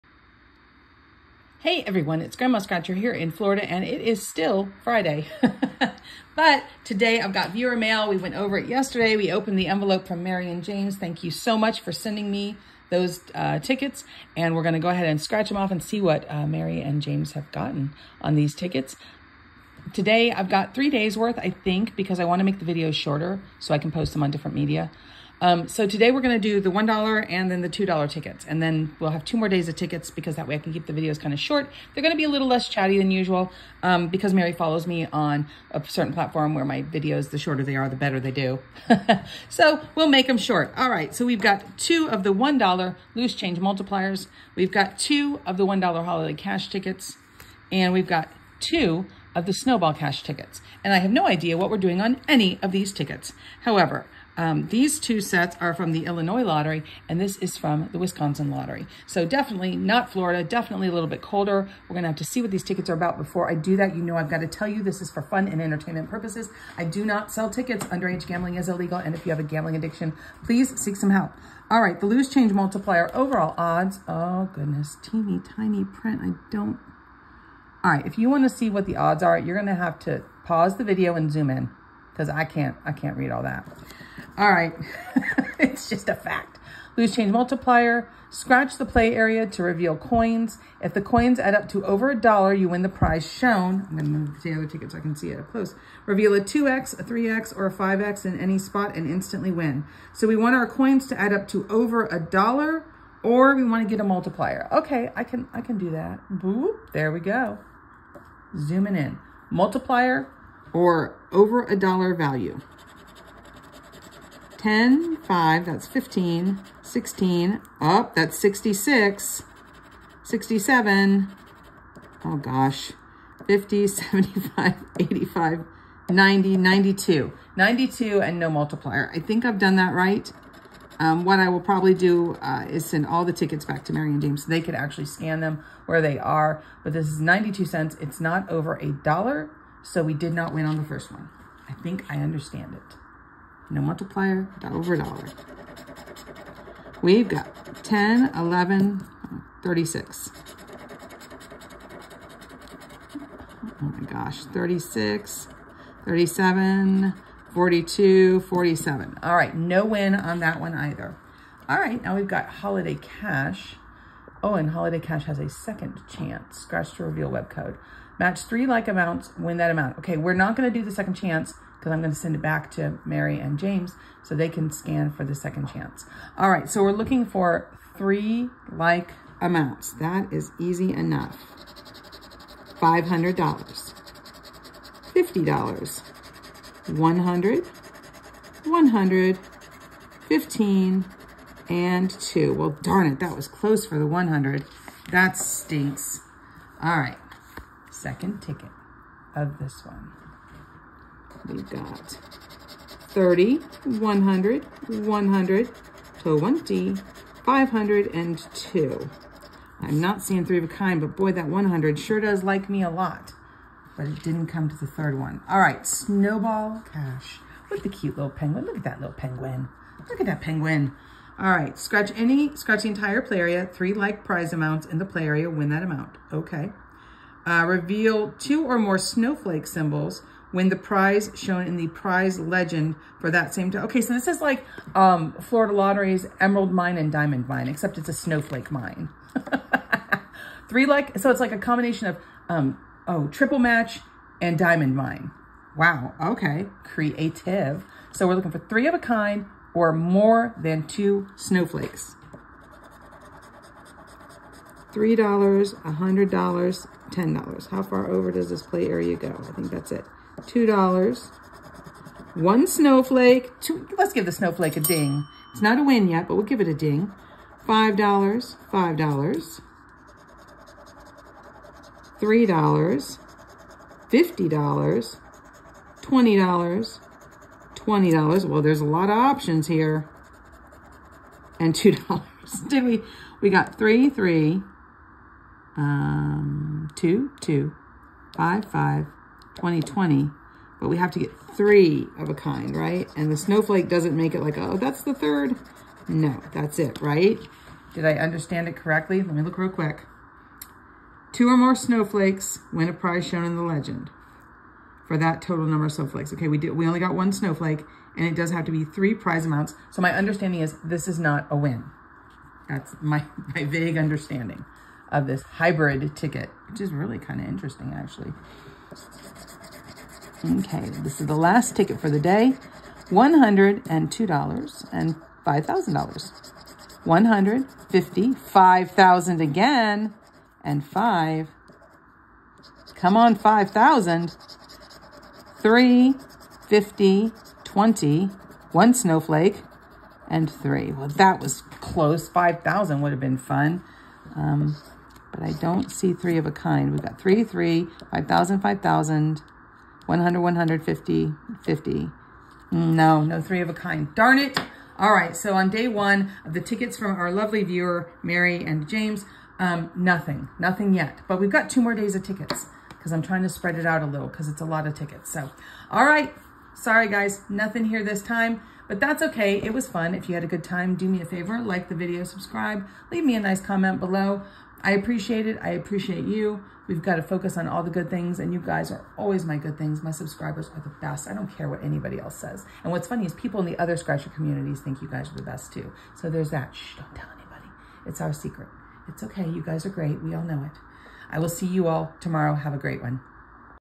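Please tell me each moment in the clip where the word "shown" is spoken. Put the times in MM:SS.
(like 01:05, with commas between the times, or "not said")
01:33, 03:51, 05:03.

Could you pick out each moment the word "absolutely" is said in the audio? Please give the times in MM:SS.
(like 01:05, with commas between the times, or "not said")
not said.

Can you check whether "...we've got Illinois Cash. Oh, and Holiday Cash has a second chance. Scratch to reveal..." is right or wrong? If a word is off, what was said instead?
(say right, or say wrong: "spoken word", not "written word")
wrong: "Holiday", not "Illinois".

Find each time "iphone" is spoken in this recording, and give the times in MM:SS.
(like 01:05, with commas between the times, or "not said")
not said.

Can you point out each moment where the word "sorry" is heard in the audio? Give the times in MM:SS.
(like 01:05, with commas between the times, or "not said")
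06:06.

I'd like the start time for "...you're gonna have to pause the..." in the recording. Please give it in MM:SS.
01:19.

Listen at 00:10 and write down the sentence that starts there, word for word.
Thank you so much for sending me those uh, tickets.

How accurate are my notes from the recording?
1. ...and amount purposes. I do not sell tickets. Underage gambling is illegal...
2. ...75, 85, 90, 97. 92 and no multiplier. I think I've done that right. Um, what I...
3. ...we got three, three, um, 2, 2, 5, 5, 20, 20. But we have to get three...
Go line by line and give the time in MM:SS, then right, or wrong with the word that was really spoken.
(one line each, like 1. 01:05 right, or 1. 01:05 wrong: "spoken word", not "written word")
1. 01:05 wrong: "entertainment", not "amount"
2. 02:03 wrong: "92", not "97"
3. 04:43 right.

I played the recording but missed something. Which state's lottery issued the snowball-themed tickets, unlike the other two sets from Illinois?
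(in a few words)
Wisconsin.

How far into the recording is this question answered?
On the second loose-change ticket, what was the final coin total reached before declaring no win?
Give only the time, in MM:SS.
02:38.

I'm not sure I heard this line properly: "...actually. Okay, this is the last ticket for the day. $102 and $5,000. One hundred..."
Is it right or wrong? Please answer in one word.
right.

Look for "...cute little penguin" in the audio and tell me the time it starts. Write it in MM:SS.
03:37.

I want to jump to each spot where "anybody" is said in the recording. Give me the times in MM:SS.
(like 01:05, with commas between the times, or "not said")
06:21, 06:27.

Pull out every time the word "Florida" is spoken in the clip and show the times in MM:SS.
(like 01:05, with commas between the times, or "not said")
00:03, 01:00, 03:55.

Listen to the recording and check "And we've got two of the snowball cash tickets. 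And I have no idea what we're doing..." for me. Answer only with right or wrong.
right.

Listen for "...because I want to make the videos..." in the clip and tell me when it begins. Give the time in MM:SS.
00:21.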